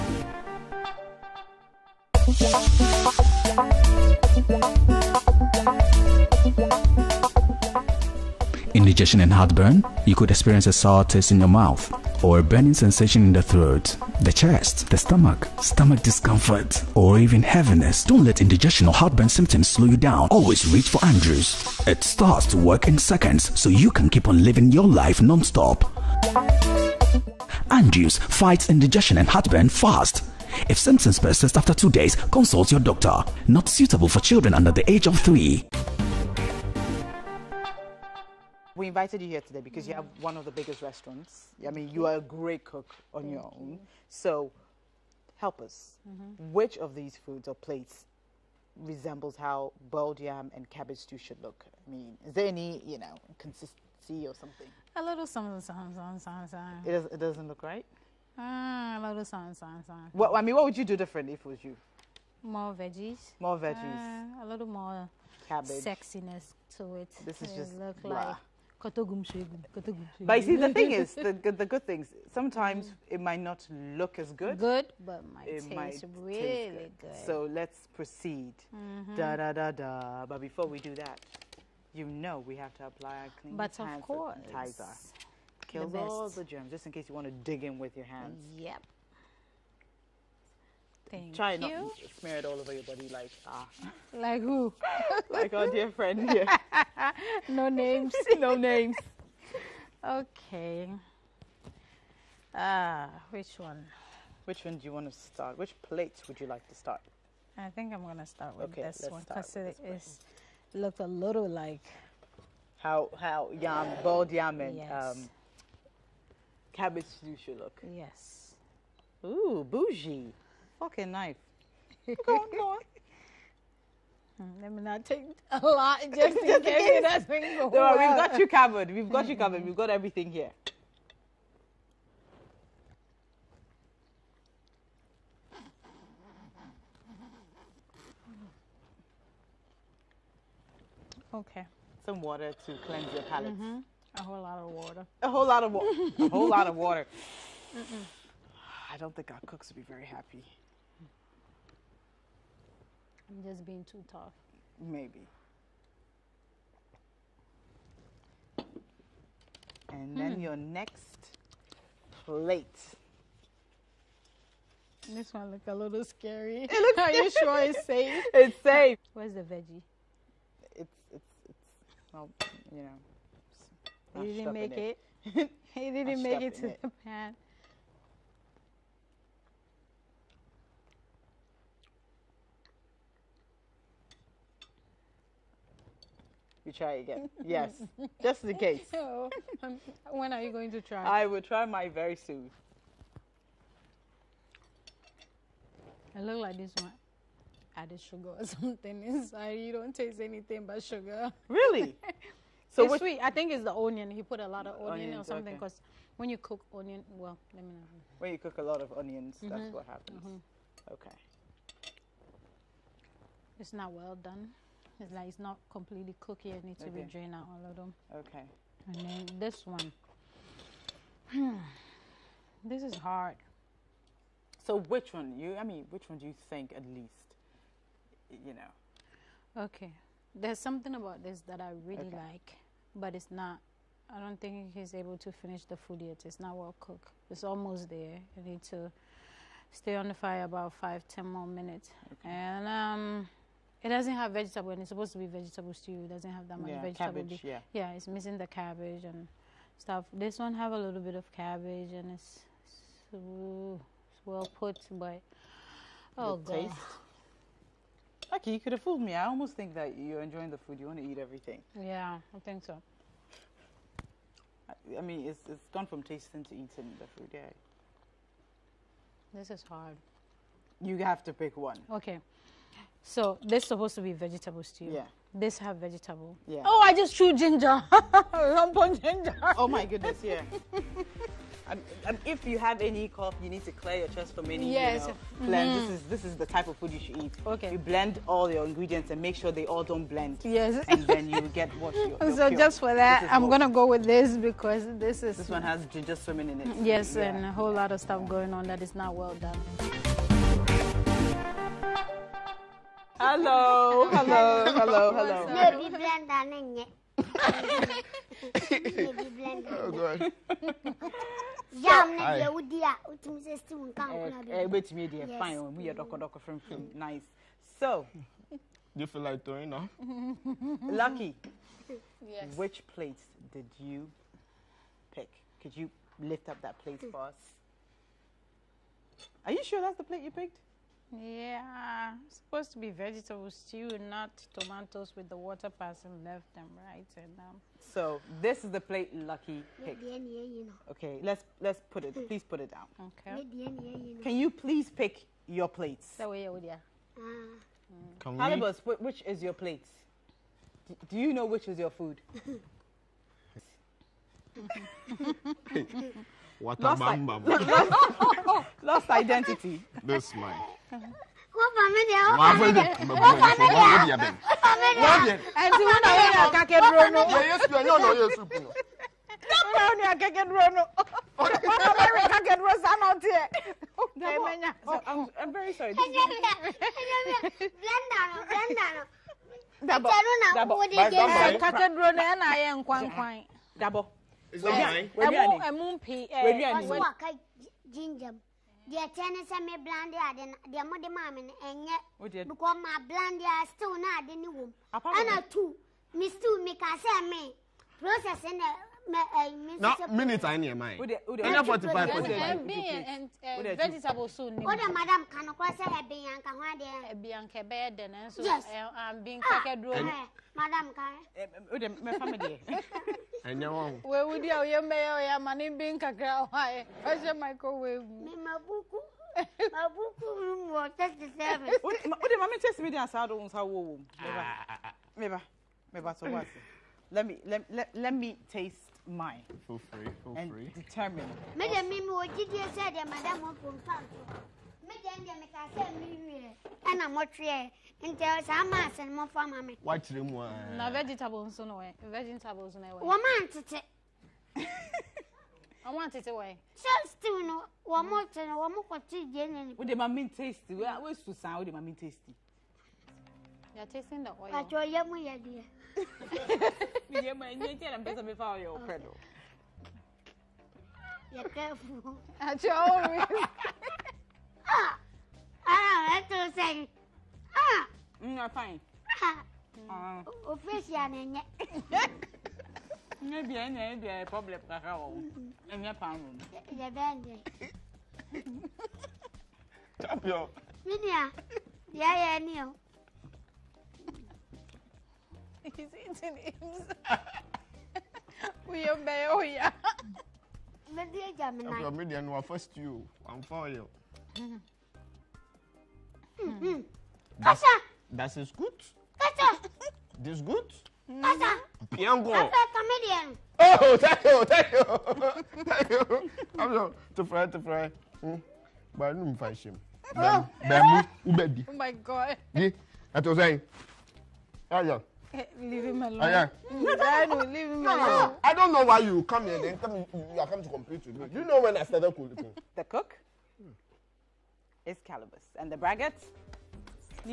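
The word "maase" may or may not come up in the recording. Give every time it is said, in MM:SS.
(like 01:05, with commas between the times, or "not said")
07:18.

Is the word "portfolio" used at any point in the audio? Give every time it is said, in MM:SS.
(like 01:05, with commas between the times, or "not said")
not said.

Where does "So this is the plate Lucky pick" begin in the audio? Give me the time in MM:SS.
05:37.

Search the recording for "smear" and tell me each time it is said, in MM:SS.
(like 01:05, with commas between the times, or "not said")
01:32.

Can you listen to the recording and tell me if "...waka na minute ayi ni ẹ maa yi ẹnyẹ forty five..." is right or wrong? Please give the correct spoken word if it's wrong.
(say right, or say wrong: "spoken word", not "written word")
right.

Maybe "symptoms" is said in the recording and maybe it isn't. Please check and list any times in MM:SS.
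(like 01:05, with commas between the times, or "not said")
00:19, 00:30.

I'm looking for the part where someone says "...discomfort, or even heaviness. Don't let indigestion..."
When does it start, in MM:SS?
00:16.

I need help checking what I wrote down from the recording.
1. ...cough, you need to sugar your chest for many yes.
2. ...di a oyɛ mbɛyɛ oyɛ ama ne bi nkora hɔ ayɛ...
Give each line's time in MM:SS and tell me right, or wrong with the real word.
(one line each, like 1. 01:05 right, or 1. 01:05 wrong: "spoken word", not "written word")
1. 04:43 wrong: "clear", not "sugar"
2. 06:54 wrong: "nkakra", not "nkora".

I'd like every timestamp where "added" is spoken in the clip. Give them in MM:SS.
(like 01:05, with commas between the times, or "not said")
03:17.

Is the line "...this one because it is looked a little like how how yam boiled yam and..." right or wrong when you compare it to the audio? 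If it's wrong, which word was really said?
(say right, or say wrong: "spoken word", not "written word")
right.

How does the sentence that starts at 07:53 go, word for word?
ne bia ne ne bia problem kakra wɔ ɛnyɛ e pan wɔ mu.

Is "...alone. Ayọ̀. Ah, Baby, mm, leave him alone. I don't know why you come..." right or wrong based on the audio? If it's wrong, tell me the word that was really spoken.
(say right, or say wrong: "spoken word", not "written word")
wrong: "Danu", not "Baby".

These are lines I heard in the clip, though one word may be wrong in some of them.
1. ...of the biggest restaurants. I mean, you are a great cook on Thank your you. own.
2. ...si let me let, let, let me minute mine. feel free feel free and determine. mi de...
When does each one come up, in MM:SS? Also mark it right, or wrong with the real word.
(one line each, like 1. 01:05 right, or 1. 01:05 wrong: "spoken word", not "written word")
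1. 00:40 right
2. 07:06 wrong: "taste", not "minute".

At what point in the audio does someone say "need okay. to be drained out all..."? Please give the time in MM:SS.
03:36.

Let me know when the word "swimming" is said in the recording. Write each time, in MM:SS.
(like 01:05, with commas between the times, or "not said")
04:56.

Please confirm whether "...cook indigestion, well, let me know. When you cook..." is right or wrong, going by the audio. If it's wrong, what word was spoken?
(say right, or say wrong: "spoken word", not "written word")
wrong: "onion", not "indigestion".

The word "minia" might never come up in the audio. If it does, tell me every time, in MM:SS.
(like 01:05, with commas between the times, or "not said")
08:00.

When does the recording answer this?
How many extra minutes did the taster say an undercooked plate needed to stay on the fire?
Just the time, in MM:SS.
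04:00.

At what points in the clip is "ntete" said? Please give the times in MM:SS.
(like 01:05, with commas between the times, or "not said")
07:23.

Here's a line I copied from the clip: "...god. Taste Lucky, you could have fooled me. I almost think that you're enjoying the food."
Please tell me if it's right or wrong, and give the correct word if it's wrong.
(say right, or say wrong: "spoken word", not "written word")
right.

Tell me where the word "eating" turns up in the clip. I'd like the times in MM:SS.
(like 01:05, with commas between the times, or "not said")
04:26, 08:05.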